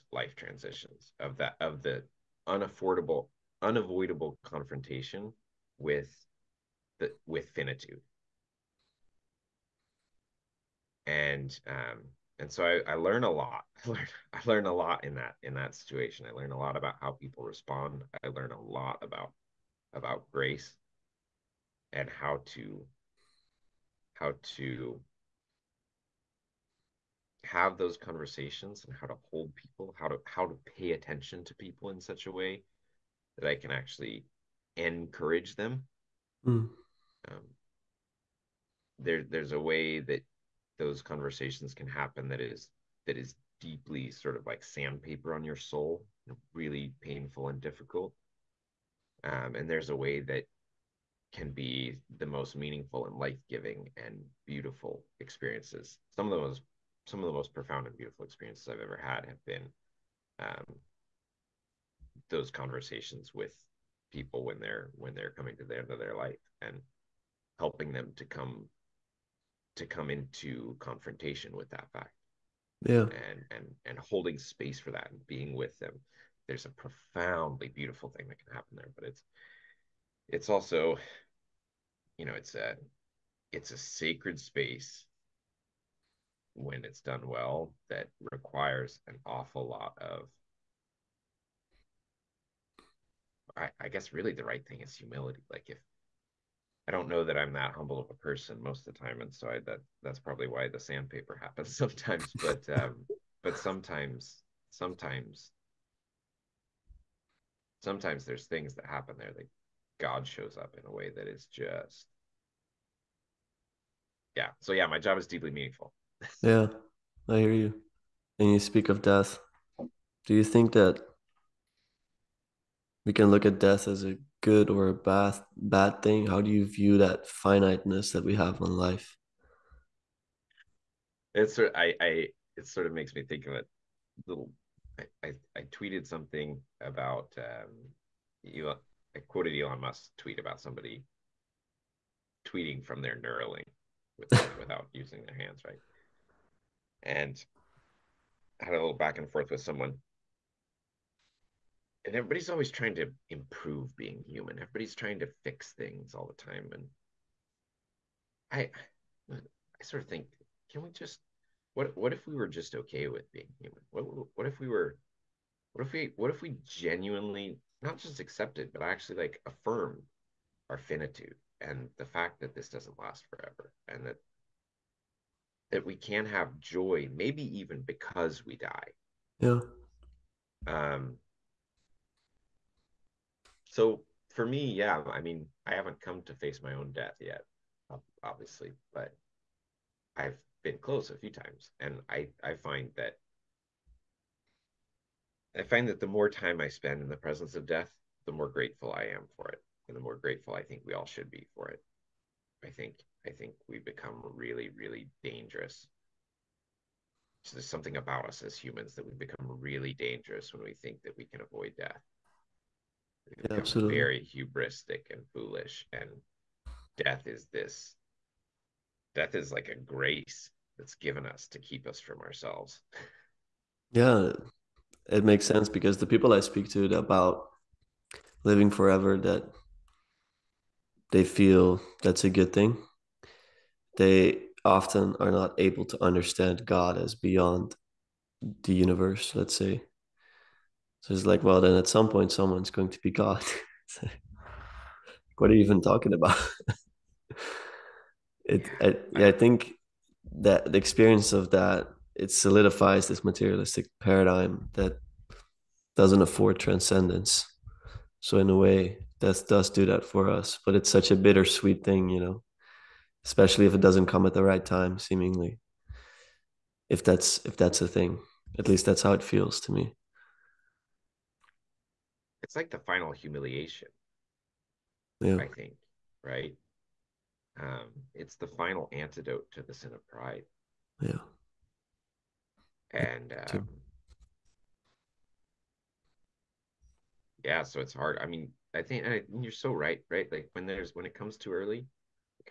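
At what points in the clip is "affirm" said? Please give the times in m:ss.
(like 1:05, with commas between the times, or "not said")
2:49.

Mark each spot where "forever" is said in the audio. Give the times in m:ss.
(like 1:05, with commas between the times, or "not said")
2:53, 3:48.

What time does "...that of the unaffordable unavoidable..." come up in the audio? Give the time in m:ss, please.
0:01.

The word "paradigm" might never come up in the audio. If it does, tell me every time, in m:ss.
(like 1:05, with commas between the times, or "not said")
4:14.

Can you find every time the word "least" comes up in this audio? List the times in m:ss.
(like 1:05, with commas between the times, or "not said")
4:28.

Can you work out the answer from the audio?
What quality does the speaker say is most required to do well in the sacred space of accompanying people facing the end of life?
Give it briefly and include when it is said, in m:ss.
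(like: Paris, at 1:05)
Humility, at 1:34.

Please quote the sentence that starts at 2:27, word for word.
And I had a little back and forth with someone.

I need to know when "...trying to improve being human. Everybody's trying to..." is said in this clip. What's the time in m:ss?
2:32.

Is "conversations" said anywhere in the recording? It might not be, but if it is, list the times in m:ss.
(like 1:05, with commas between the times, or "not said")
0:27, 0:41, 1:02.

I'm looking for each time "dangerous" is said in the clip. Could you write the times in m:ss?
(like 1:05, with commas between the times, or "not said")
3:25, 3:29.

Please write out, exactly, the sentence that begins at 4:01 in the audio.
So it's like, well, then at some point someone's going to be God.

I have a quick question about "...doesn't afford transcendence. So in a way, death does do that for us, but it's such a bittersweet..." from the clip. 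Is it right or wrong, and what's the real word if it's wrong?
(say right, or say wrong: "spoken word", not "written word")
right.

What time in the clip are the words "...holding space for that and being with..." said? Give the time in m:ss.
1:13.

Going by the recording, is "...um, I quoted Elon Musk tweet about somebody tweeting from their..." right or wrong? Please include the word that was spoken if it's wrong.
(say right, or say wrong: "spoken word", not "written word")
right.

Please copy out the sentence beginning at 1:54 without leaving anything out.
So yeah, my job is deeply meaningful.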